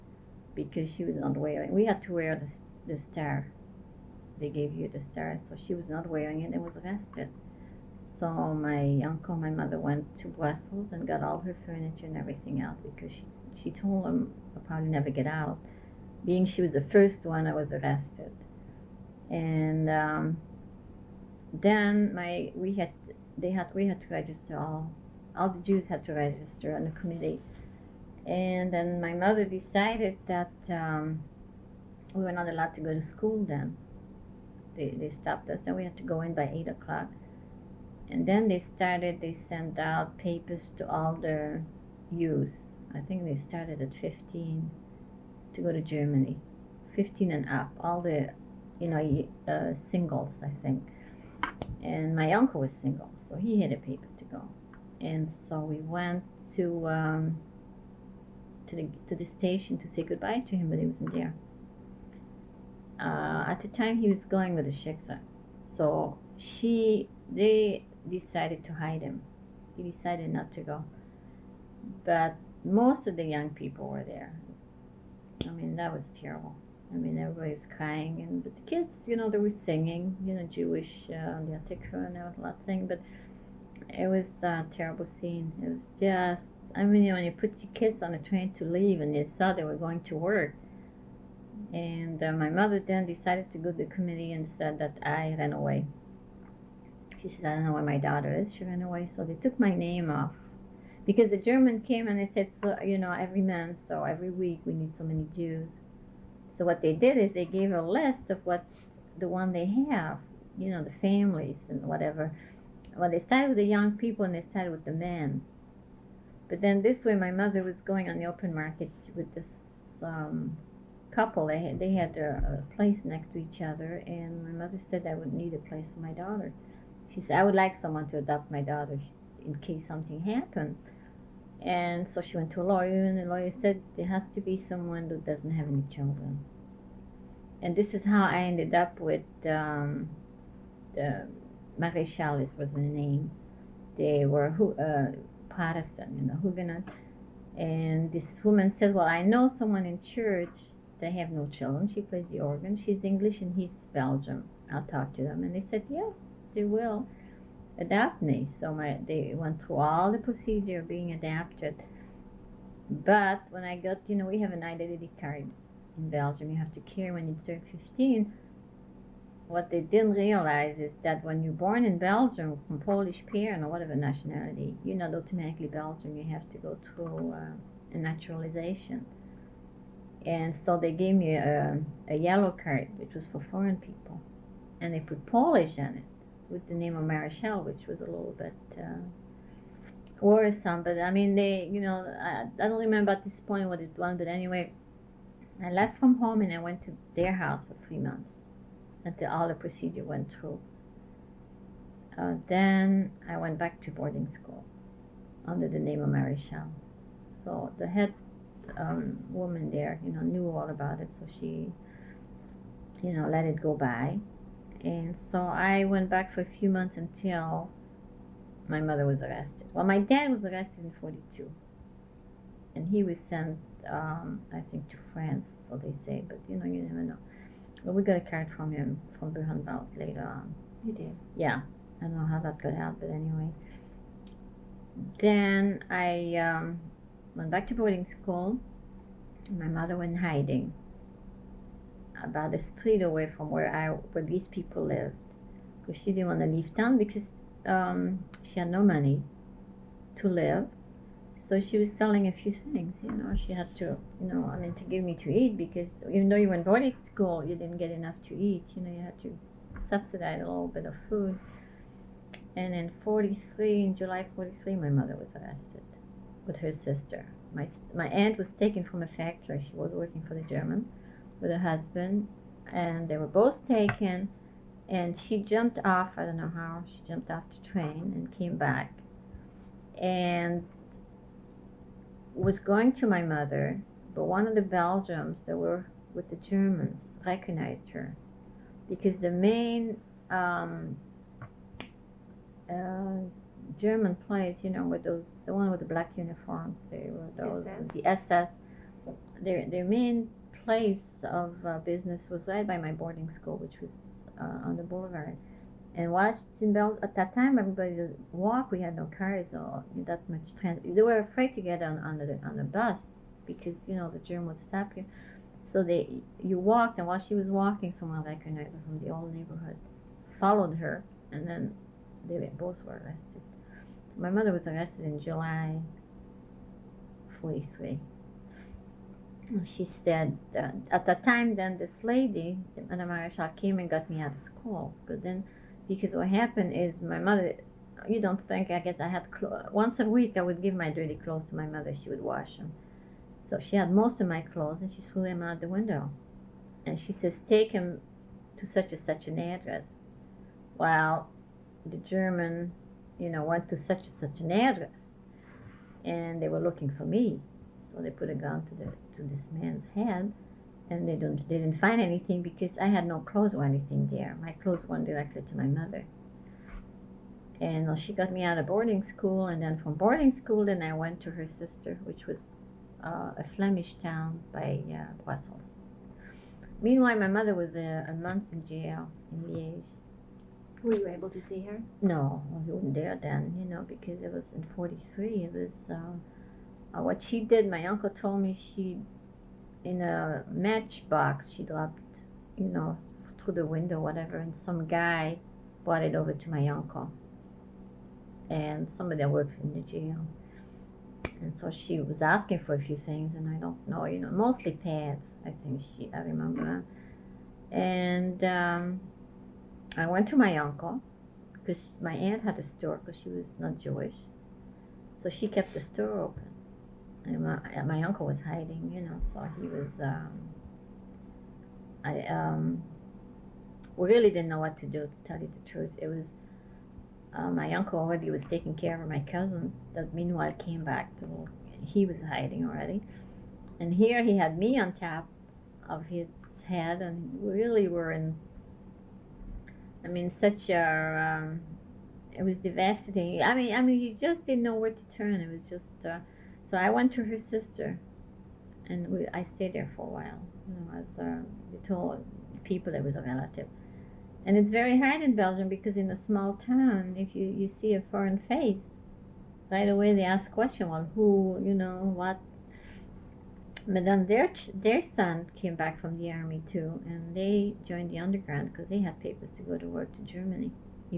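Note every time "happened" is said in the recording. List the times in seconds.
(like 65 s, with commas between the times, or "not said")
130 s, 336 s.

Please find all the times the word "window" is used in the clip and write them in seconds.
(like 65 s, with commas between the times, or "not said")
345 s, 393 s.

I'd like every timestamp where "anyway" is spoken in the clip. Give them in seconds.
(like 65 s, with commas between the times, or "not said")
194 s, 233 s.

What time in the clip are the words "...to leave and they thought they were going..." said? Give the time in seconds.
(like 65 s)
88 s.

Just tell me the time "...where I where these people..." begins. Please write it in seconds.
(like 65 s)
243 s.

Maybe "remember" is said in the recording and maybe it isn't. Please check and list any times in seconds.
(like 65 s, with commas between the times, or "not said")
192 s, 406 s.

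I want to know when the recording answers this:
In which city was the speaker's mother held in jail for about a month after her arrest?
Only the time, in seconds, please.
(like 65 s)
379 s.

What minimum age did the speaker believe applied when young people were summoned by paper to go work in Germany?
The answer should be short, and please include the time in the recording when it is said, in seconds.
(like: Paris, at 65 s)
15, at 46 s.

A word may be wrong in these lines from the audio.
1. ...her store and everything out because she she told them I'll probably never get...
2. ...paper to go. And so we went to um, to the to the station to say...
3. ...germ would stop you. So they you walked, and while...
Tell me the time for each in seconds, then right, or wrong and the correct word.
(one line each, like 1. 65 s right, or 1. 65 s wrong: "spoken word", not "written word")
1. 11 s wrong: "furniture", not "store"
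2. 53 s right
3. 314 s right.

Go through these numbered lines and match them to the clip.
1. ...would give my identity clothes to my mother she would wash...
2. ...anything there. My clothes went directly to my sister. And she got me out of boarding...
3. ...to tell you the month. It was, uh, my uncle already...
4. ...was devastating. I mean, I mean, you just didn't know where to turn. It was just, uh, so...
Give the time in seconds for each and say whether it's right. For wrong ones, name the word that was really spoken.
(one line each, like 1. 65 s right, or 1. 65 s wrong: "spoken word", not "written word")
1. 340 s wrong: "dirty", not "identity"
2. 363 s wrong: "mother", not "sister"
3. 425 s wrong: "truth", not "month"
4. 442 s right.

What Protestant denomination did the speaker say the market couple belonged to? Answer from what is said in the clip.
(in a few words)
Huguenot.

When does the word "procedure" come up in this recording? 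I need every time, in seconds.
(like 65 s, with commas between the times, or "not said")
160 s, 199 s.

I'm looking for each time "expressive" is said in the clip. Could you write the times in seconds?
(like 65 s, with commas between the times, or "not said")
not said.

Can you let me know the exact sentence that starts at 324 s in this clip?
So my mother was arrested in July 43.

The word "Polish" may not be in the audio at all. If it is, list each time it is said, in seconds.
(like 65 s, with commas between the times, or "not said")
172 s, 185 s.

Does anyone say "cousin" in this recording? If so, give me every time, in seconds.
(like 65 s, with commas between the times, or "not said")
429 s.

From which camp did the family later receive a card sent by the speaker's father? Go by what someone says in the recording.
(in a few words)
Buchenwald.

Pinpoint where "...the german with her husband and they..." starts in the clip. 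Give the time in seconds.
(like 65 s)
270 s.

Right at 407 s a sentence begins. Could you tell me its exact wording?
And um, I went to my uncle because my aunt had a store because she was not Jewish.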